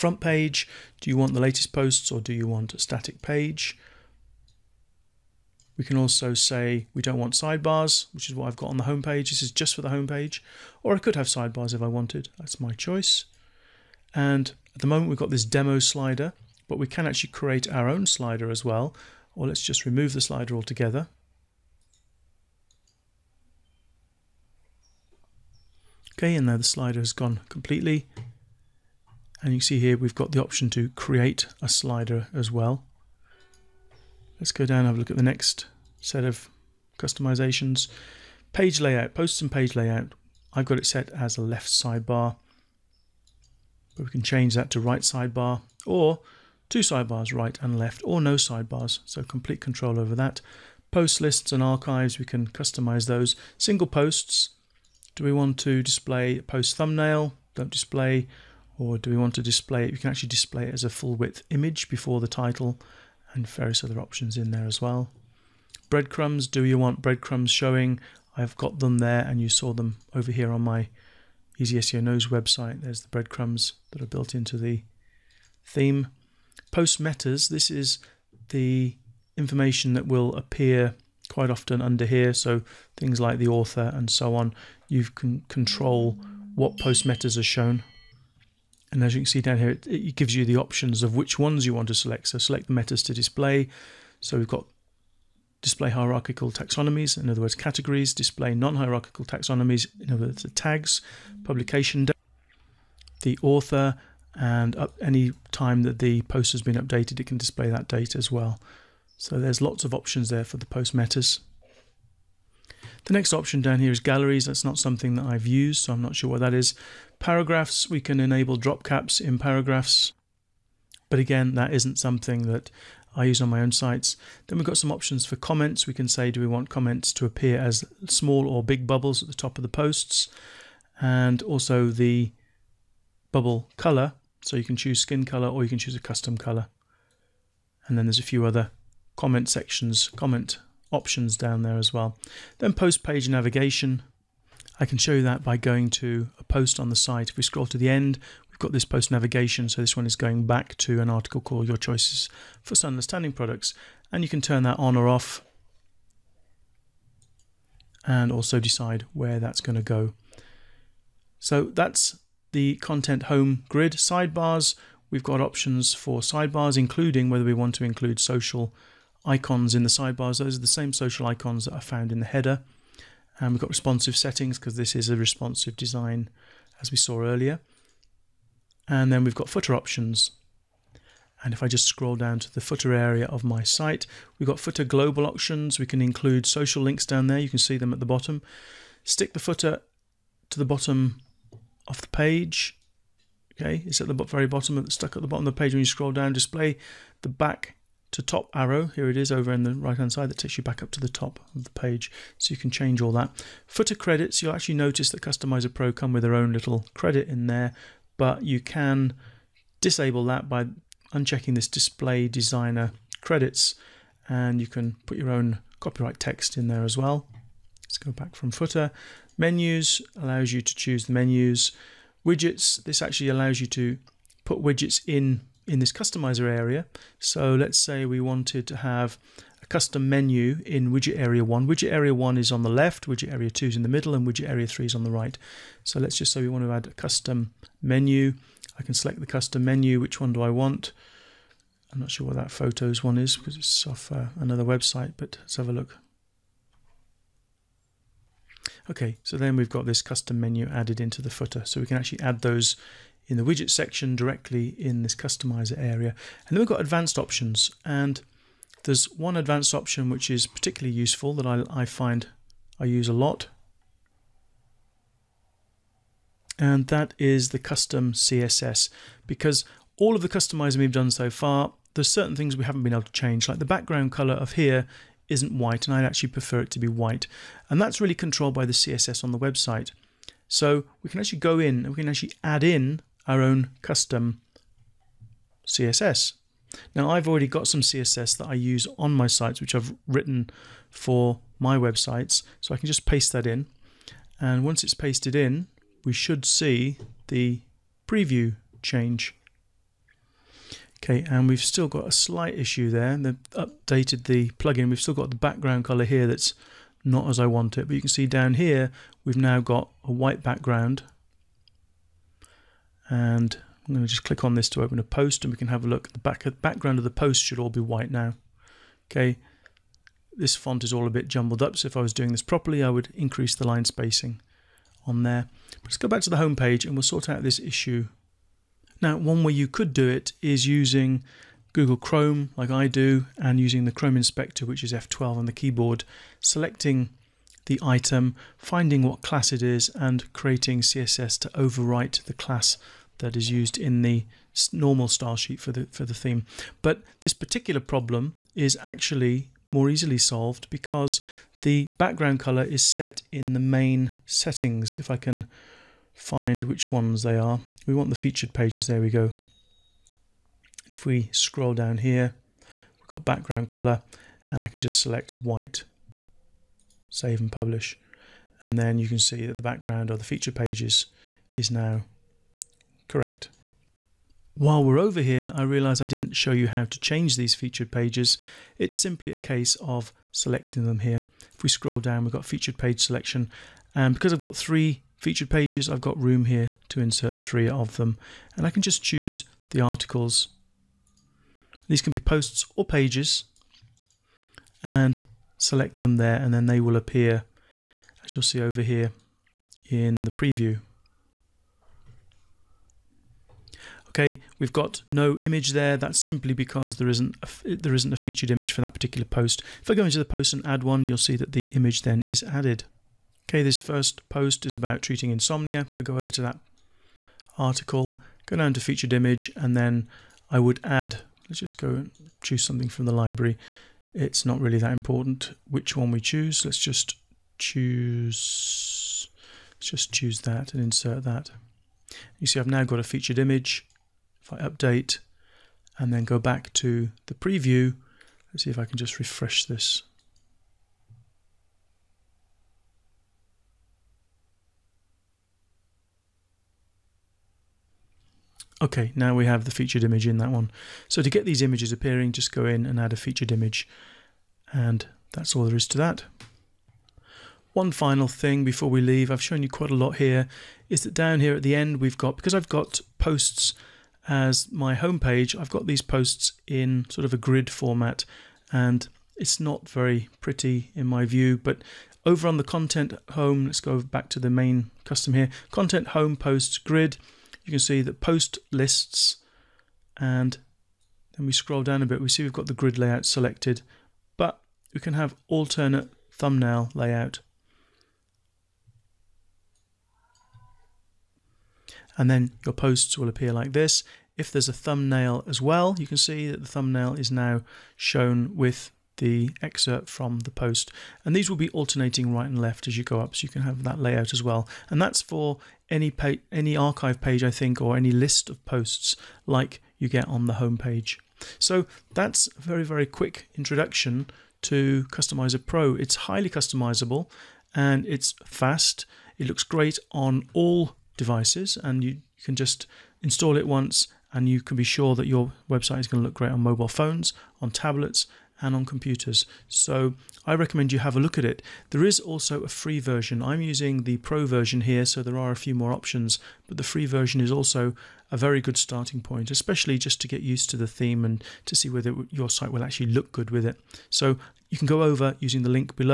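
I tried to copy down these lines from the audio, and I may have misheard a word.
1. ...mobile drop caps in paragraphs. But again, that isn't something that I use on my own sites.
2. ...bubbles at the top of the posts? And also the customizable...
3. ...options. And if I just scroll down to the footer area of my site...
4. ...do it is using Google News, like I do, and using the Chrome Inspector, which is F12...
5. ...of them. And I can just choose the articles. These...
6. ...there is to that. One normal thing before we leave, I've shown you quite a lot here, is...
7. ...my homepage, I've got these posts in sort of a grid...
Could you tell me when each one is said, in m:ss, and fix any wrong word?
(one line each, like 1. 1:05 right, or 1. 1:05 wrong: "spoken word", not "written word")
1. 1:58 wrong: "enable", not "mobile"
2. 2:08 wrong: "bubble", not "customizable"
3. 2:59 right
4. 5:29 wrong: "Chrome", not "News"
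5. 6:27 right
6. 7:35 wrong: "final", not "normal"
7. 7:44 right.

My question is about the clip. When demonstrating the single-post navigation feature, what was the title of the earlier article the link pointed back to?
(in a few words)
Your Choices for Sun Products.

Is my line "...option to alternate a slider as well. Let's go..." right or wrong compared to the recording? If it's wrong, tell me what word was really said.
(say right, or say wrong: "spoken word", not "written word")
wrong: "create", not "alternate".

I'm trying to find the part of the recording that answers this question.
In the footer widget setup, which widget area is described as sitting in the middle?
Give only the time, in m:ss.
3:53.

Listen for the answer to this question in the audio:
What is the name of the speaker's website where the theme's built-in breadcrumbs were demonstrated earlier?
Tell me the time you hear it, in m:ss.
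1:11.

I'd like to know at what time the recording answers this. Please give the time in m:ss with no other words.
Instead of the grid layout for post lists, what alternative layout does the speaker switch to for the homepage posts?
8:05.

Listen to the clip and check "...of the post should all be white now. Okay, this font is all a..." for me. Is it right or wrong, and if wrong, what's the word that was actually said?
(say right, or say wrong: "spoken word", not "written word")
right.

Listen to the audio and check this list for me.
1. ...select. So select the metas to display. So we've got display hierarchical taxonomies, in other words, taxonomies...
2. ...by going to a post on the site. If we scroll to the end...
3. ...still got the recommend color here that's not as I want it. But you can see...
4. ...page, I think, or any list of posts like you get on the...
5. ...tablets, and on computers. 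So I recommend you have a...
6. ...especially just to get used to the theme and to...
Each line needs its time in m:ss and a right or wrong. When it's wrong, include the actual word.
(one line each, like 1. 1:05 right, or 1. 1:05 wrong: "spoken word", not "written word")
1. 1:31 wrong: "categories", not "taxonomies"
2. 2:25 right
3. 5:05 wrong: "background", not "recommend"
4. 8:27 right
5. 8:47 right
6. 8:59 right.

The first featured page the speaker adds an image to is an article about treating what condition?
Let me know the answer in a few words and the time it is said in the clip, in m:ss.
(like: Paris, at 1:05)
Insomnia, at 6:55.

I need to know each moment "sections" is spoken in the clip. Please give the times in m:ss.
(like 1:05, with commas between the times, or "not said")
2:19, 4:13.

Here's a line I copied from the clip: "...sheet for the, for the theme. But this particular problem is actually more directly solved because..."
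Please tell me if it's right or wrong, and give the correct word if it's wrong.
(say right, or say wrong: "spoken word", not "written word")
wrong: "easily", not "directly".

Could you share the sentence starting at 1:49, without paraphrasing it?
So there's lots of options there for the post metas.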